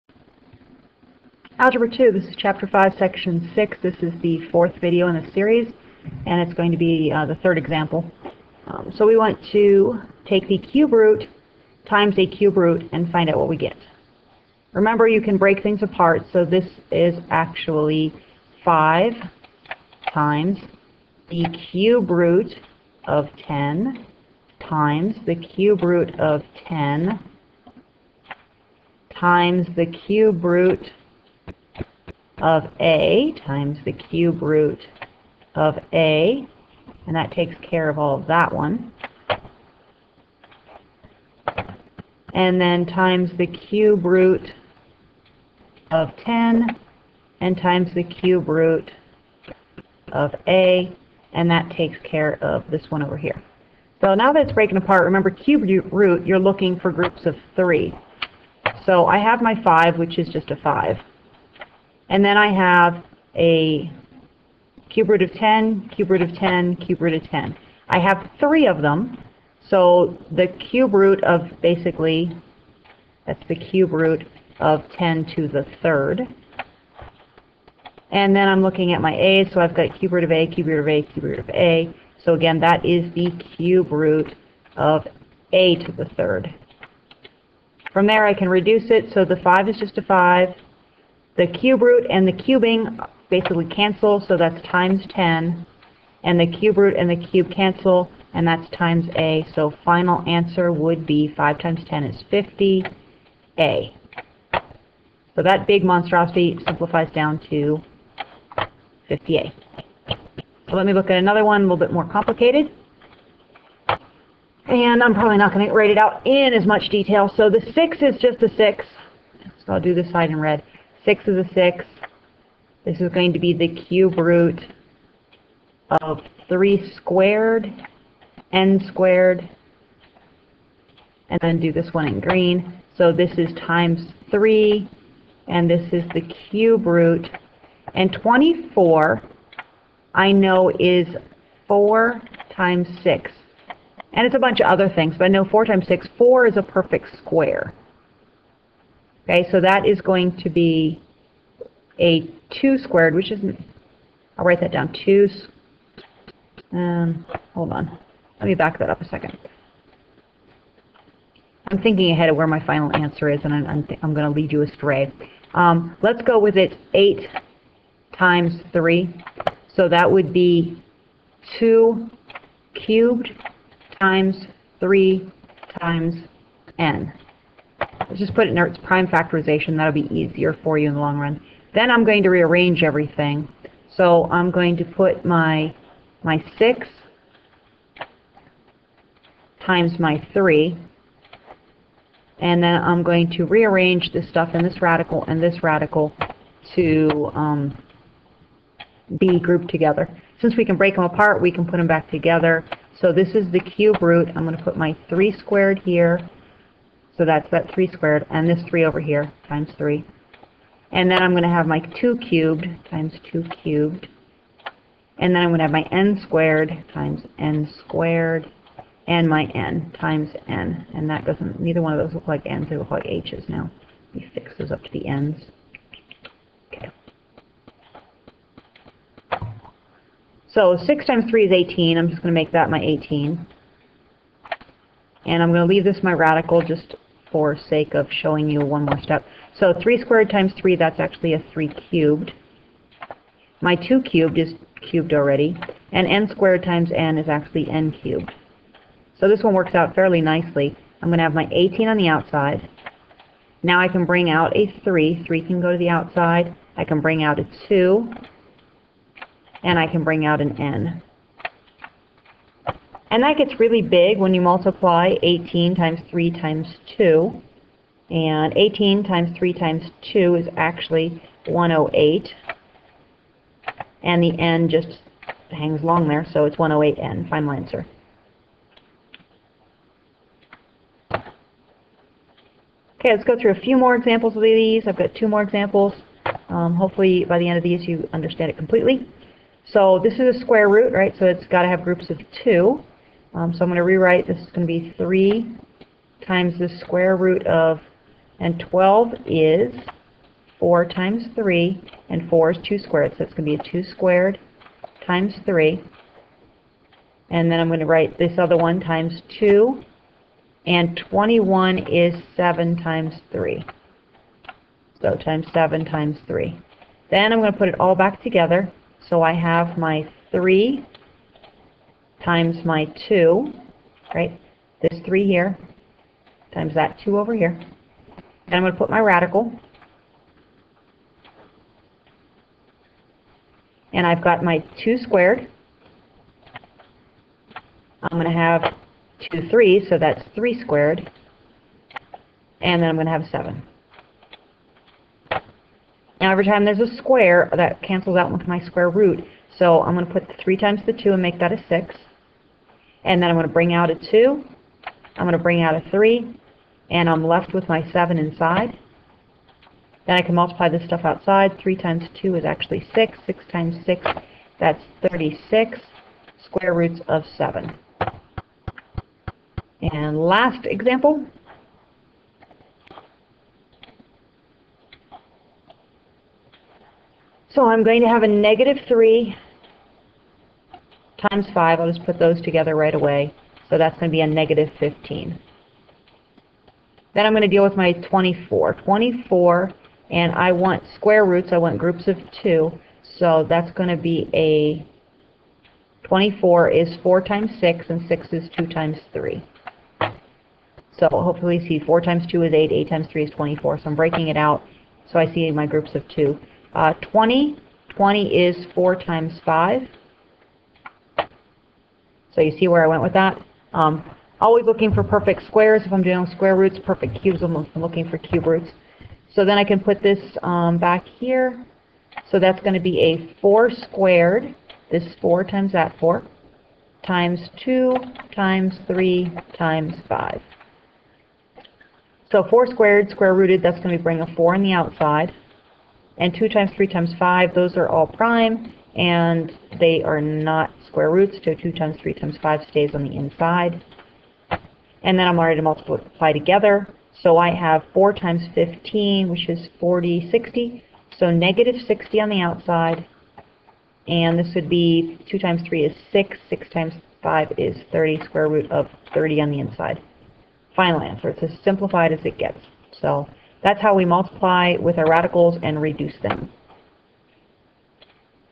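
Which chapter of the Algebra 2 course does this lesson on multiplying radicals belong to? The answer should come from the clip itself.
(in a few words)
Chapter 5.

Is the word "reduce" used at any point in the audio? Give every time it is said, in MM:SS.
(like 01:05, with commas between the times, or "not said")
01:28, 07:45.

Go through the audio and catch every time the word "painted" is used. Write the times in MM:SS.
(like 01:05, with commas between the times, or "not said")
not said.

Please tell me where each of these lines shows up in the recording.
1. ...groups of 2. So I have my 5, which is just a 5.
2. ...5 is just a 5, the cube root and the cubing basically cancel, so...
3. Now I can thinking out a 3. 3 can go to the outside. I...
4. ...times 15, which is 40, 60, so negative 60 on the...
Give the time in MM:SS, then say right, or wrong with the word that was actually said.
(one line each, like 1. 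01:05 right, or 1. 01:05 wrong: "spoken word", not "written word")
1. 00:56 wrong: "3", not "2"
2. 01:29 right
3. 04:13 wrong: "bring", not "thinking"
4. 07:28 right.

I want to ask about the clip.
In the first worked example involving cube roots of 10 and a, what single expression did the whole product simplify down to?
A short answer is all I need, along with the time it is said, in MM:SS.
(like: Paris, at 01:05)
50A, at 01:49.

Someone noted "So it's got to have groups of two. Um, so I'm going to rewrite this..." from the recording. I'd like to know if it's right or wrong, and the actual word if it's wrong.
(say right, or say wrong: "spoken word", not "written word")
right.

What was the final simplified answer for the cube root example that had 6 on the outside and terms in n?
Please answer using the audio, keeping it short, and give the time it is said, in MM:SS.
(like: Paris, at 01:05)
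108n, at 04:36.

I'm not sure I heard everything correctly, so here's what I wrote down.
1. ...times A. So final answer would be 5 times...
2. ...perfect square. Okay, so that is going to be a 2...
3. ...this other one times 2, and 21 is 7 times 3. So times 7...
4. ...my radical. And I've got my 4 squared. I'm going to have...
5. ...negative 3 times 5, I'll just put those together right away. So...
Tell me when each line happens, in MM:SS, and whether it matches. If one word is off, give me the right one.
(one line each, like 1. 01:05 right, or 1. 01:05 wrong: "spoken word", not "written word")
1. 01:38 right
2. 02:26 right
3. 05:08 right
4. 05:28 wrong: "2", not "4"
5. 06:18 right.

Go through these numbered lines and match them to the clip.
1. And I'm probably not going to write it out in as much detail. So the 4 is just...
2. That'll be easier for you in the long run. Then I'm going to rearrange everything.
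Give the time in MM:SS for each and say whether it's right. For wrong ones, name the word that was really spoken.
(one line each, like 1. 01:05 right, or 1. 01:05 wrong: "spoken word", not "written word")
1. 01:54 wrong: "6", not "4"
2. 02:59 right.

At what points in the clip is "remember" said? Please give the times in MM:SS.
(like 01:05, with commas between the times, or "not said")
00:14, 00:55.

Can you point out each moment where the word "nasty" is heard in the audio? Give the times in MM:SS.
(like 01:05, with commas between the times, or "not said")
not said.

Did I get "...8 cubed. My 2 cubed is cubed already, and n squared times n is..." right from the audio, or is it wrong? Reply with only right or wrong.
wrong.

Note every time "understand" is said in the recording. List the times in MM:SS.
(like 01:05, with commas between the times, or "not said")
04:48.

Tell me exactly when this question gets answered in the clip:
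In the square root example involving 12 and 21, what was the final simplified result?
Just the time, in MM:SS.
06:05.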